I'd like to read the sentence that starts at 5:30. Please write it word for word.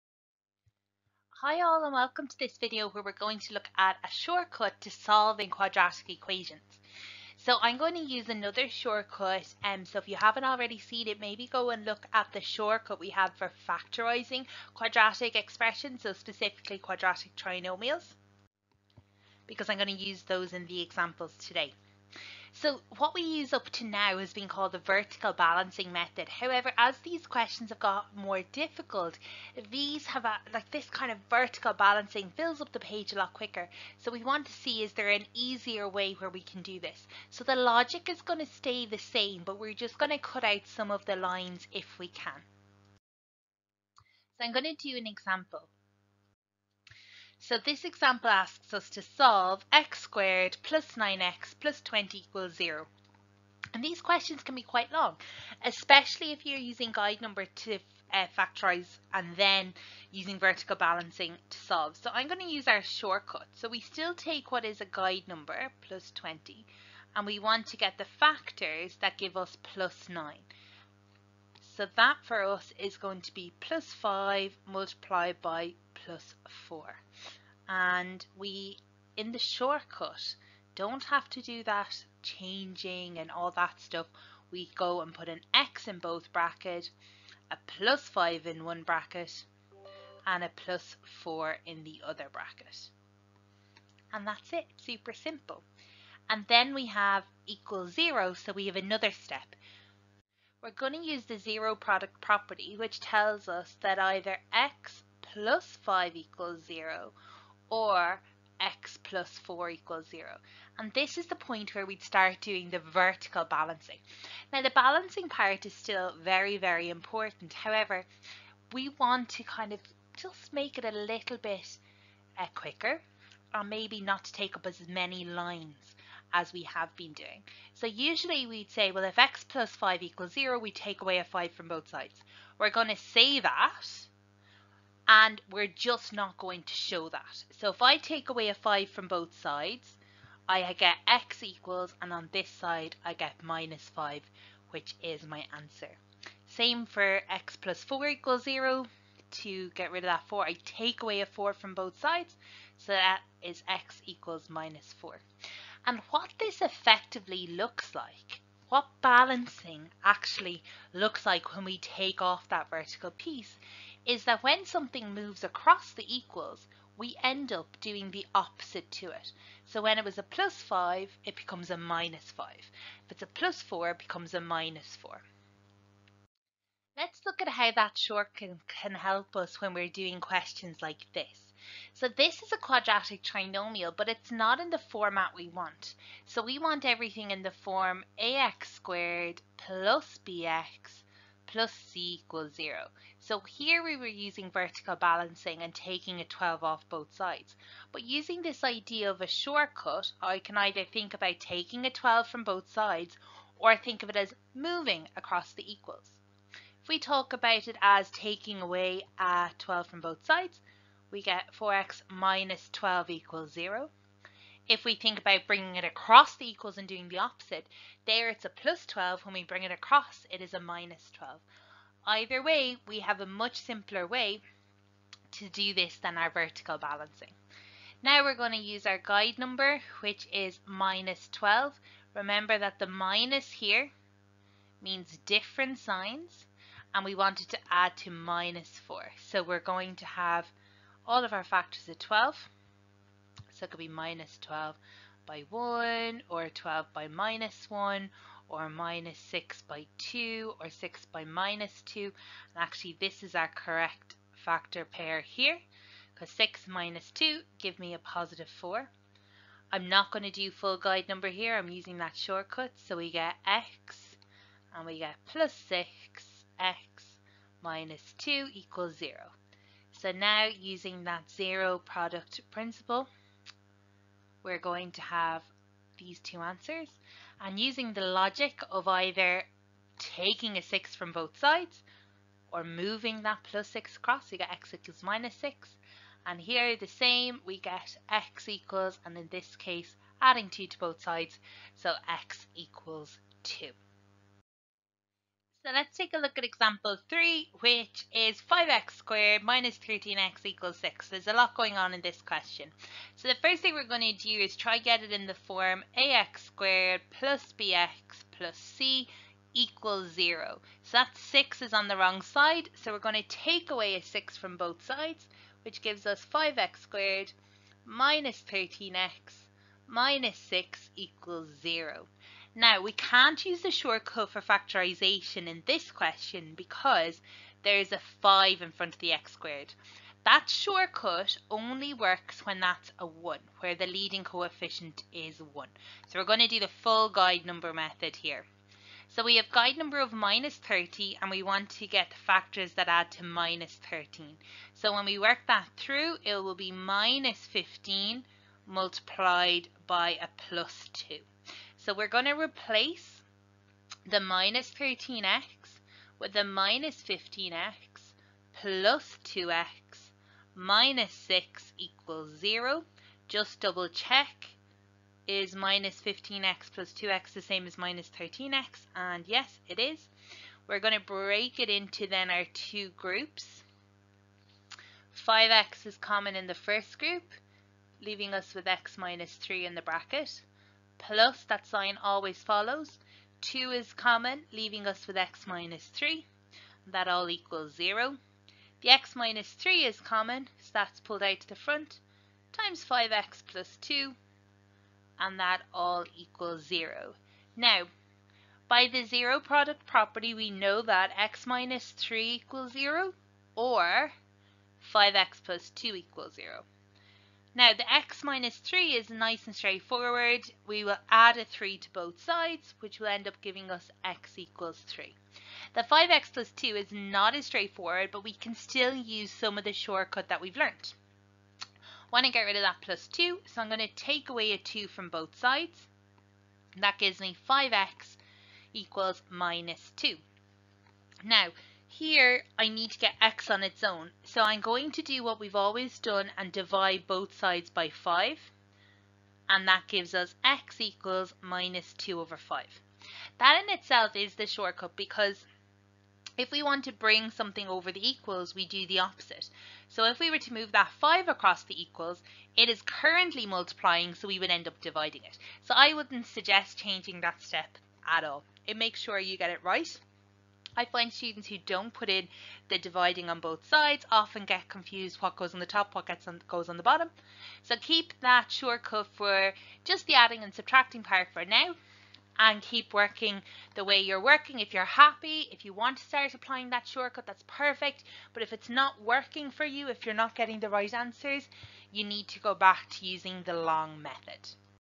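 That shortcut only works when that's a 1, where the leading coefficient is 1.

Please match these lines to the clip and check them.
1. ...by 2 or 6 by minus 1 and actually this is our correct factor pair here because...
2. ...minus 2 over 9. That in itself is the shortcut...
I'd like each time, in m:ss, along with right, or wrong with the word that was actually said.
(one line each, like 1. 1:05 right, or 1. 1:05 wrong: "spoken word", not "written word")
1. 4:09 wrong: "2", not "1"
2. 7:21 wrong: "5", not "9".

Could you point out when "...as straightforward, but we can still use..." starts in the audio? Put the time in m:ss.
6:57.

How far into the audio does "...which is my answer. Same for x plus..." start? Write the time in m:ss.
2:24.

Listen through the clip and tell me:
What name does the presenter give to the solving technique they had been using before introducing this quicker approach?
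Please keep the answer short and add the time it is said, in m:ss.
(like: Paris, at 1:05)
vertical balancing method, at 0:24.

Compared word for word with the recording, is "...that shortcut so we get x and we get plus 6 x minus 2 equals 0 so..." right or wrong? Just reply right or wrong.
right.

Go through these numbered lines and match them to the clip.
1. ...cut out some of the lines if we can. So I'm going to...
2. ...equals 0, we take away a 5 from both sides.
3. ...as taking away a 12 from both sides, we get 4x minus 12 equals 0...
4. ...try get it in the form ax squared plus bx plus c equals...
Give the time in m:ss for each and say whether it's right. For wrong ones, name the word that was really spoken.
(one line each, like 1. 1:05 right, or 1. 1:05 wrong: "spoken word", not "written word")
1. 0:40 right
2. 2:10 right
3. 3:27 right
4. 5:04 right.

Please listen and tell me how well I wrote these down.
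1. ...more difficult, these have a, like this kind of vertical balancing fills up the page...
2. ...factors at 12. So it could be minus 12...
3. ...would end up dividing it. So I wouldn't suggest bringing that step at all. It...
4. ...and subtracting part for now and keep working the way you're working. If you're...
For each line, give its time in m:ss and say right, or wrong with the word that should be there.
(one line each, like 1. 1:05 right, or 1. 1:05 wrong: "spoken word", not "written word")
1. 0:28 right
2. 4:01 right
3. 7:34 wrong: "changing", not "bringing"
4. 7:50 right.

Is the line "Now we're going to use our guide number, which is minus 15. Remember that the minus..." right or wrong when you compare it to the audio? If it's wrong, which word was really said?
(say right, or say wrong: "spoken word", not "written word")
wrong: "12", not "15".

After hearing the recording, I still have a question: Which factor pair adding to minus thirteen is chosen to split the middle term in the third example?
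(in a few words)
-15 and 2.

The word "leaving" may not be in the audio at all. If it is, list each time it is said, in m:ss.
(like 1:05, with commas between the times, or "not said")
6:18, 6:24.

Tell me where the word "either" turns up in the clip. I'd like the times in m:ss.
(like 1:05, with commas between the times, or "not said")
1:43, 3:20, 3:42, 4:38.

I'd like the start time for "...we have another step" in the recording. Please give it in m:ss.
1:38.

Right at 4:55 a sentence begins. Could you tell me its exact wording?
So let's take a look at example 3, which is 5x squared minus 13x equals 6.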